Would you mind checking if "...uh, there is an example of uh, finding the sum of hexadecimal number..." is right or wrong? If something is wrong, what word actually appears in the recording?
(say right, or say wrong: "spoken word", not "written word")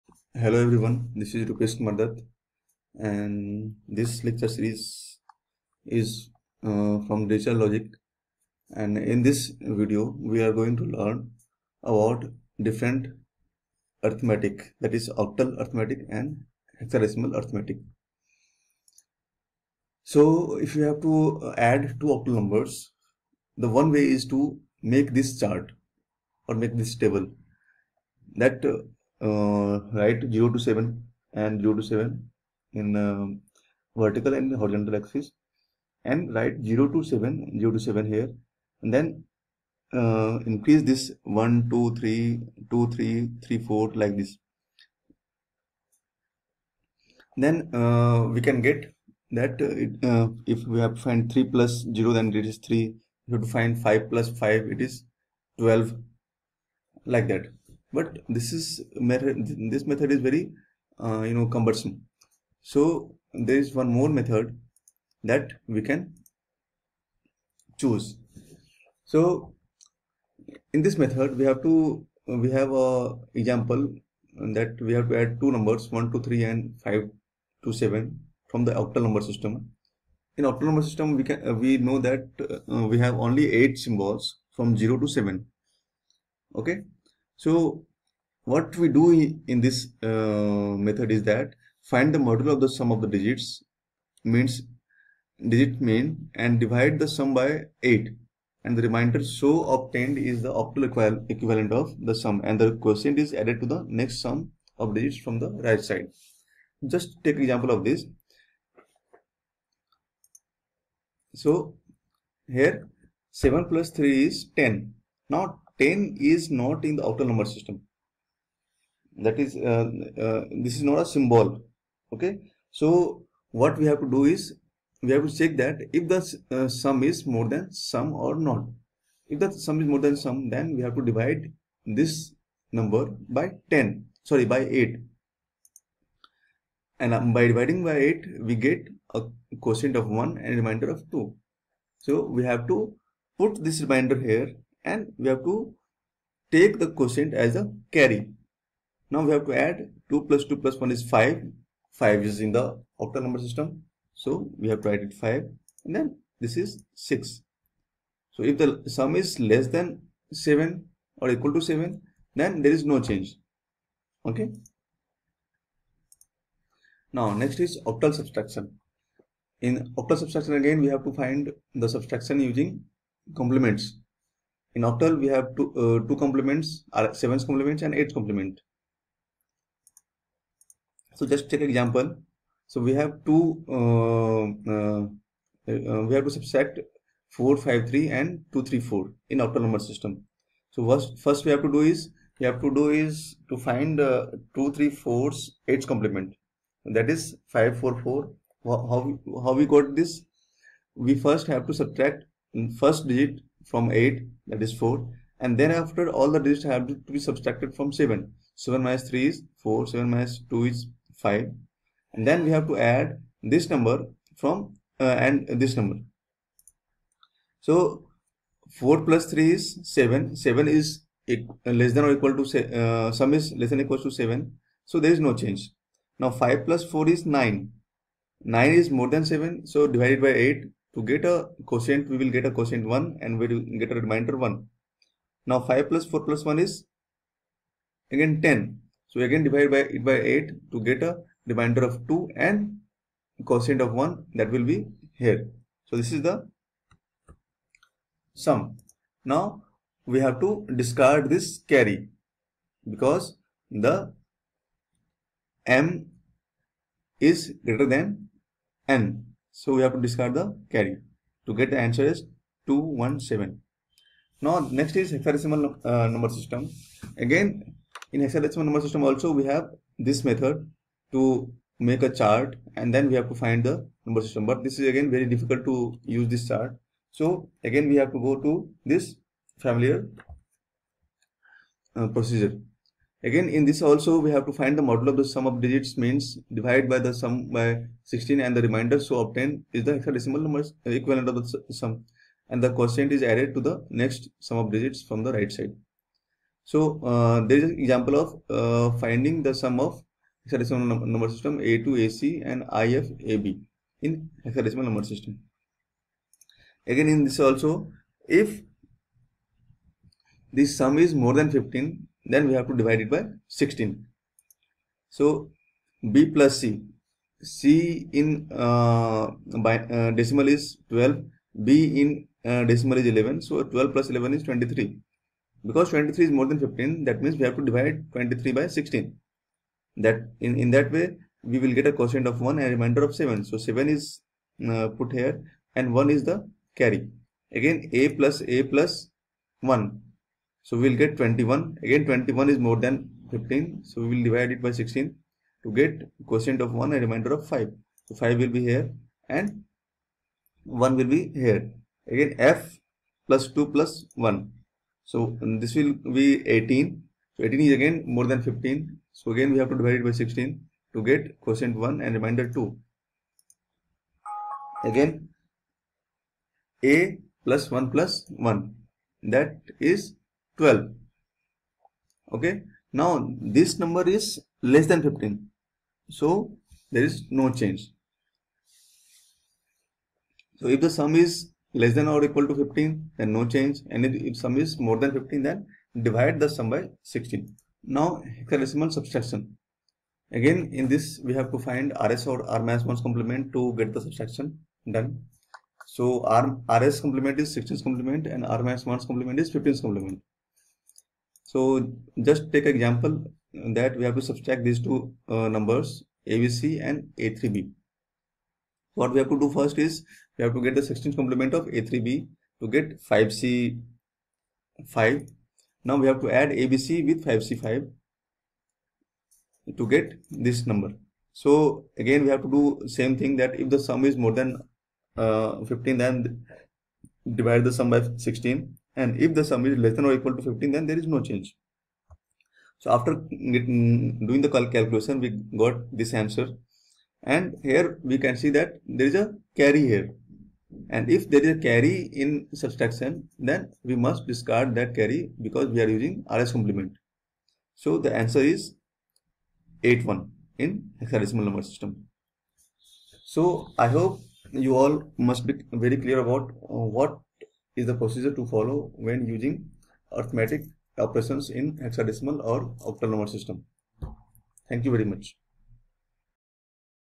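right.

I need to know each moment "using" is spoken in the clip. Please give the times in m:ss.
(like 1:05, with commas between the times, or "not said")
2:52, 7:25, 7:39.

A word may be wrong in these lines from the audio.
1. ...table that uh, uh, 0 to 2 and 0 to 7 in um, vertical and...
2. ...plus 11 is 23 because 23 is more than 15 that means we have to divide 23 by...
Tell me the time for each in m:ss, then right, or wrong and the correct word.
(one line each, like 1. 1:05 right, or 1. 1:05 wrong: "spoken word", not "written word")
1. 0:26 wrong: "7", not "2"
2. 5:23 right.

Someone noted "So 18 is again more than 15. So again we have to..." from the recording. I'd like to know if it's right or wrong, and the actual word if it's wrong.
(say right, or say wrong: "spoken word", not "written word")
right.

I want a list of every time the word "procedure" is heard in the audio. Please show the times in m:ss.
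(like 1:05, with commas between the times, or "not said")
4:42, 7:37.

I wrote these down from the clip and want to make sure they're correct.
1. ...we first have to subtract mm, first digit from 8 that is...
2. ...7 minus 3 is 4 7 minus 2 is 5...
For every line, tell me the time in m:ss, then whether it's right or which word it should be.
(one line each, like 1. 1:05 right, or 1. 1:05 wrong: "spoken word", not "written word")
1. 3:20 right
2. 3:28 right.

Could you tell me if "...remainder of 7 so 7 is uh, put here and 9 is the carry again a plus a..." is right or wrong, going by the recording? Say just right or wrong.
wrong.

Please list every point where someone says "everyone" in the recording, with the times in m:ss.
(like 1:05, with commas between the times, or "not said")
0:00.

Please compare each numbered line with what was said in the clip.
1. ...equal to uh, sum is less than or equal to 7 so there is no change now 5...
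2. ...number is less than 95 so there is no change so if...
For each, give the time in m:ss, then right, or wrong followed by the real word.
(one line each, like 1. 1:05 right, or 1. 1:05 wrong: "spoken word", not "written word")
1. 3:42 right
2. 6:13 wrong: "15", not "95".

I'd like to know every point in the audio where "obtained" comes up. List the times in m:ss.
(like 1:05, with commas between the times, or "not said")
1:39, 4:49.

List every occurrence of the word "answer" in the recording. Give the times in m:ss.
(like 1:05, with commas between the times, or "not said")
4:21, 7:16, 7:28.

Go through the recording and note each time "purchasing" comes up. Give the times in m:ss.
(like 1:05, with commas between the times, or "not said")
not said.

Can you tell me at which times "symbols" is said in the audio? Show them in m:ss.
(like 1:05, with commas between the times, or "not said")
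1:23, 2:01.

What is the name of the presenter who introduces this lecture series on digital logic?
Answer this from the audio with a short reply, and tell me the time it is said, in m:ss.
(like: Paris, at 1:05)
Rupesh Mardat, at 0:01.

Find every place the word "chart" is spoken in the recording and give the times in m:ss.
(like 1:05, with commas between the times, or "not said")
0:25, 4:32, 4:36.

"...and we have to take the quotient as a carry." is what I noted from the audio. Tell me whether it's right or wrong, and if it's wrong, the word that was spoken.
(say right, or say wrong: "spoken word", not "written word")
right.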